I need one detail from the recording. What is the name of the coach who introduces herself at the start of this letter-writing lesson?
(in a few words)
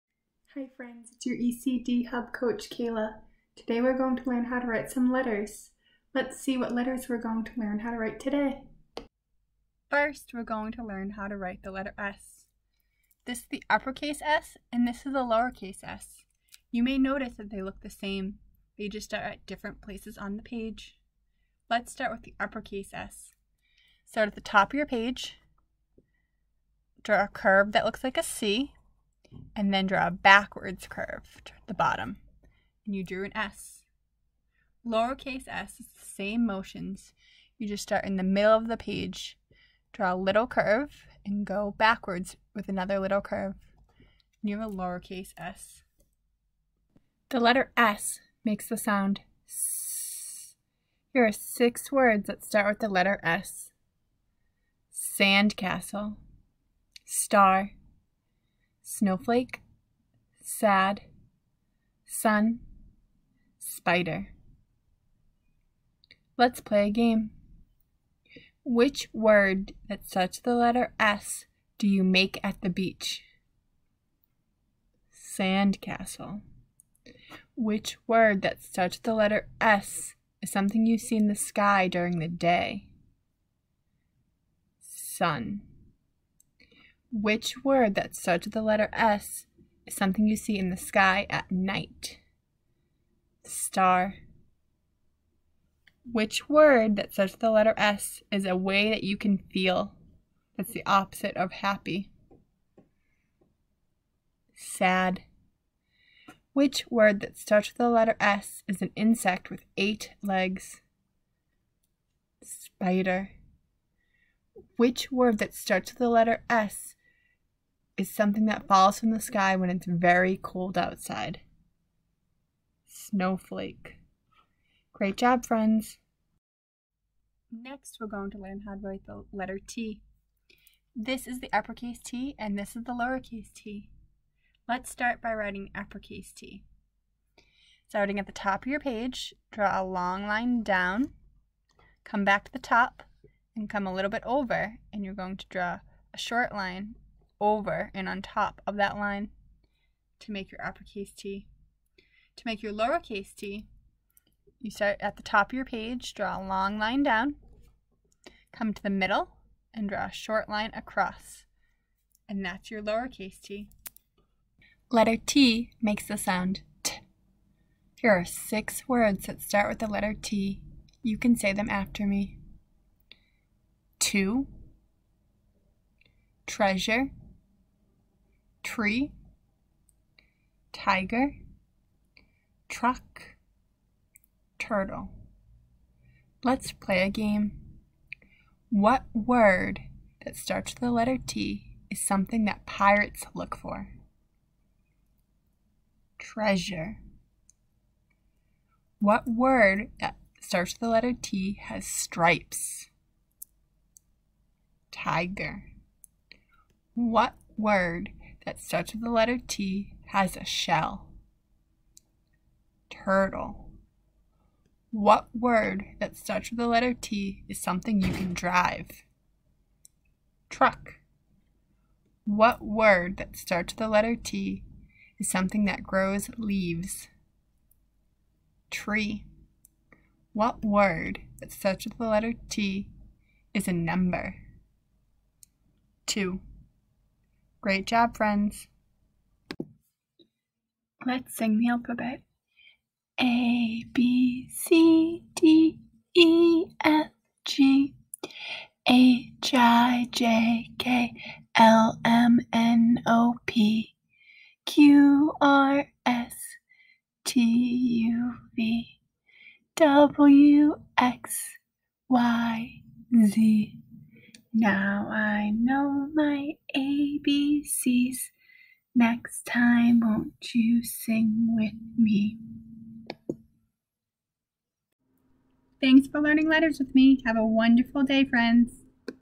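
Kayla.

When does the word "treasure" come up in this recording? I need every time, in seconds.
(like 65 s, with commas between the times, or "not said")
176 s, 196 s.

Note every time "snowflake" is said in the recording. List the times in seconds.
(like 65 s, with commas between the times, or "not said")
58 s, 122 s.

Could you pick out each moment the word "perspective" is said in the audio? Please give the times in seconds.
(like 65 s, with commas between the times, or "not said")
not said.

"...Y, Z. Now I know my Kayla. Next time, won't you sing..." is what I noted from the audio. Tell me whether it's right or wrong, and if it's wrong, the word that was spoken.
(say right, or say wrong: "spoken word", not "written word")
wrong: "ABCs", not "Kayla".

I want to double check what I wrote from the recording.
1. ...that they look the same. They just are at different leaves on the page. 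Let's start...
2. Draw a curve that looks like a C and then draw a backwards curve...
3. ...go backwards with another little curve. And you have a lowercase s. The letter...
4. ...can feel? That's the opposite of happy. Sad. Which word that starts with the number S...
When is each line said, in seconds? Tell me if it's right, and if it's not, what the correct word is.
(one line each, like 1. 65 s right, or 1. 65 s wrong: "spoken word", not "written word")
1. 17 s wrong: "places", not "leaves"
2. 27 s right
3. 41 s right
4. 99 s wrong: "letter", not "number".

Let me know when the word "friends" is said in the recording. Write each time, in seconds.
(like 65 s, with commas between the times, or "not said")
0 s, 125 s, 238 s, 278 s.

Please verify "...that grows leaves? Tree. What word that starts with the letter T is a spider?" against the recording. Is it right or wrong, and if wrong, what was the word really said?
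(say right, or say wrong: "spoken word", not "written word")
wrong: "number", not "spider".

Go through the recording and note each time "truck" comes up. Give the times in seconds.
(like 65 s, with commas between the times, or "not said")
182 s, 220 s.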